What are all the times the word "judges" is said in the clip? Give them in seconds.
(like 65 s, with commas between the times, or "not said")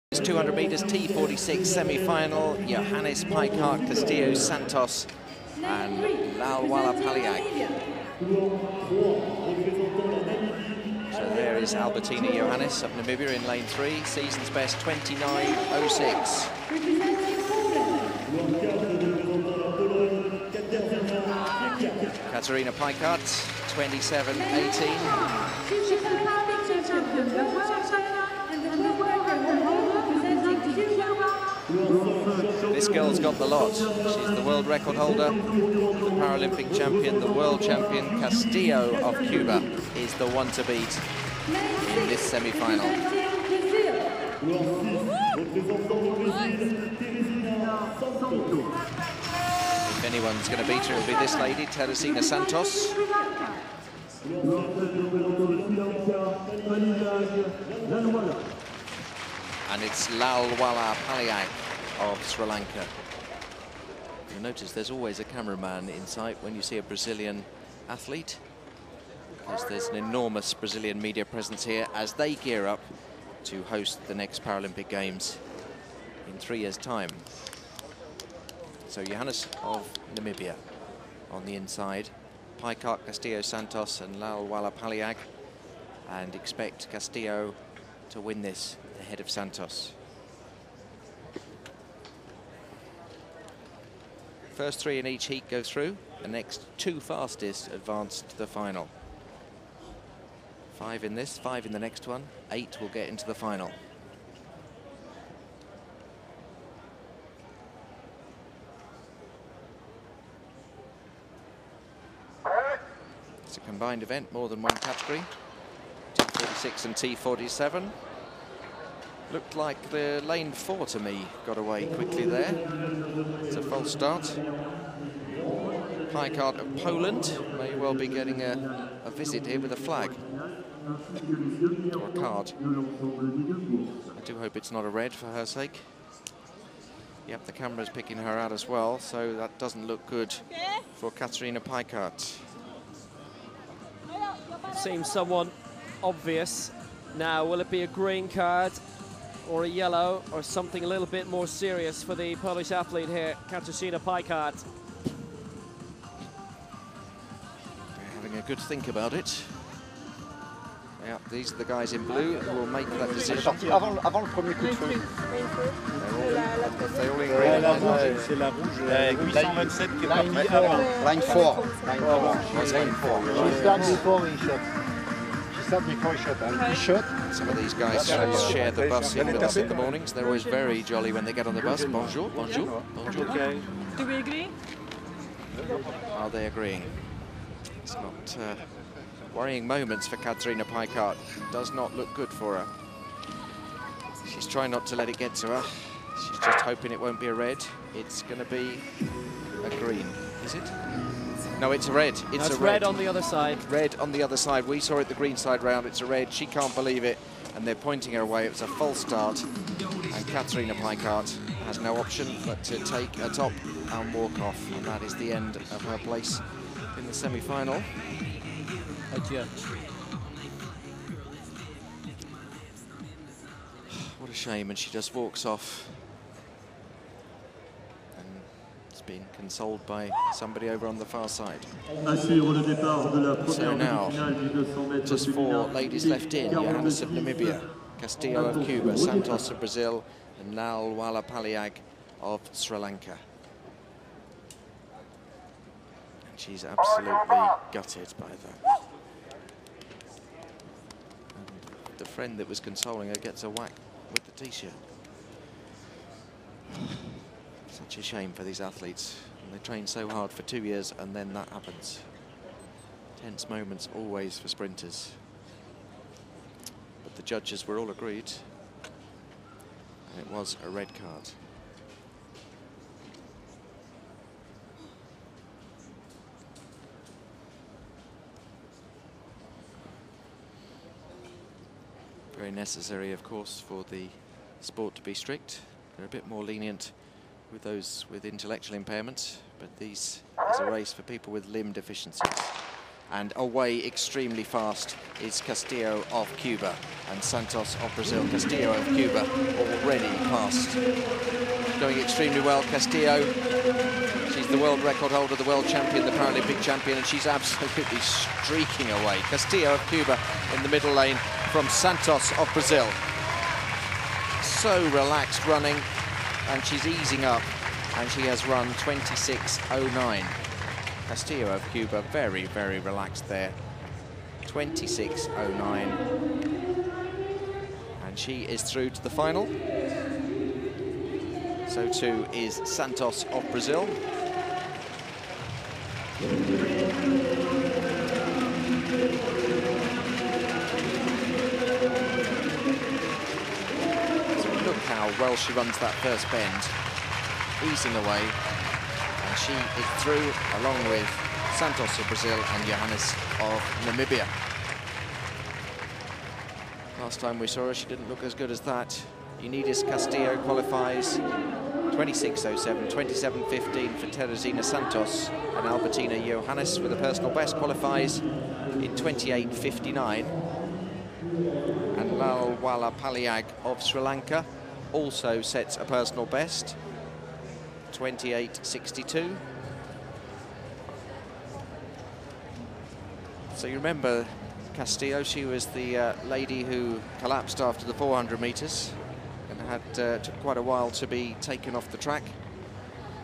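267 s.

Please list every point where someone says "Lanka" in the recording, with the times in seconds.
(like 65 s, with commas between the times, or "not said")
62 s, 242 s, 374 s.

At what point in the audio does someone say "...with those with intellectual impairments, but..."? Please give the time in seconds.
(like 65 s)
287 s.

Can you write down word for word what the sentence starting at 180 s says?
They're always very jolly when they get on the bus.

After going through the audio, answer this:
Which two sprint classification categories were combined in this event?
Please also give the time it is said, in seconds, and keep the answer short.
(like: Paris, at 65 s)
T46 and T47, at 116 s.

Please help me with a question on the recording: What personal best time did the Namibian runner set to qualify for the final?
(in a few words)
28.59.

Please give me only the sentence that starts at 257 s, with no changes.
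Such a shame for these athletes.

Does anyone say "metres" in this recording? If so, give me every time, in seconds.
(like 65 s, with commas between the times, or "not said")
0 s, 388 s.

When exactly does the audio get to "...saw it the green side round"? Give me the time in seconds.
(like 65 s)
204 s.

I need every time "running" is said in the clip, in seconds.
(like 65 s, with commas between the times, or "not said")
315 s.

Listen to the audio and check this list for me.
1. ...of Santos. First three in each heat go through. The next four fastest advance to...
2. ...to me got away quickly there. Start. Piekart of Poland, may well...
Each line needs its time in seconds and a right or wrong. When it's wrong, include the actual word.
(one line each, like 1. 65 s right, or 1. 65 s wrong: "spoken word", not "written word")
1. 89 s wrong: "two", not "four"
2. 120 s right.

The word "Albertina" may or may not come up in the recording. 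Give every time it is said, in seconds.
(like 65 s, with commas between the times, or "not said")
11 s, 365 s.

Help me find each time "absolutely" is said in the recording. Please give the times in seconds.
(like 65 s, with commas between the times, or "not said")
246 s, 307 s.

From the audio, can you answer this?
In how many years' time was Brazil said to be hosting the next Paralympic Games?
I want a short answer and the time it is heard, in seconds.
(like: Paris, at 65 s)
3, at 76 s.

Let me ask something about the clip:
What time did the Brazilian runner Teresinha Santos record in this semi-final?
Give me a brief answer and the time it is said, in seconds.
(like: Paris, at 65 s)
27.15, at 362 s.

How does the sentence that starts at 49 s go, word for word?
If anyone's going to beat her, it'll be this lady, Teresinha Santos.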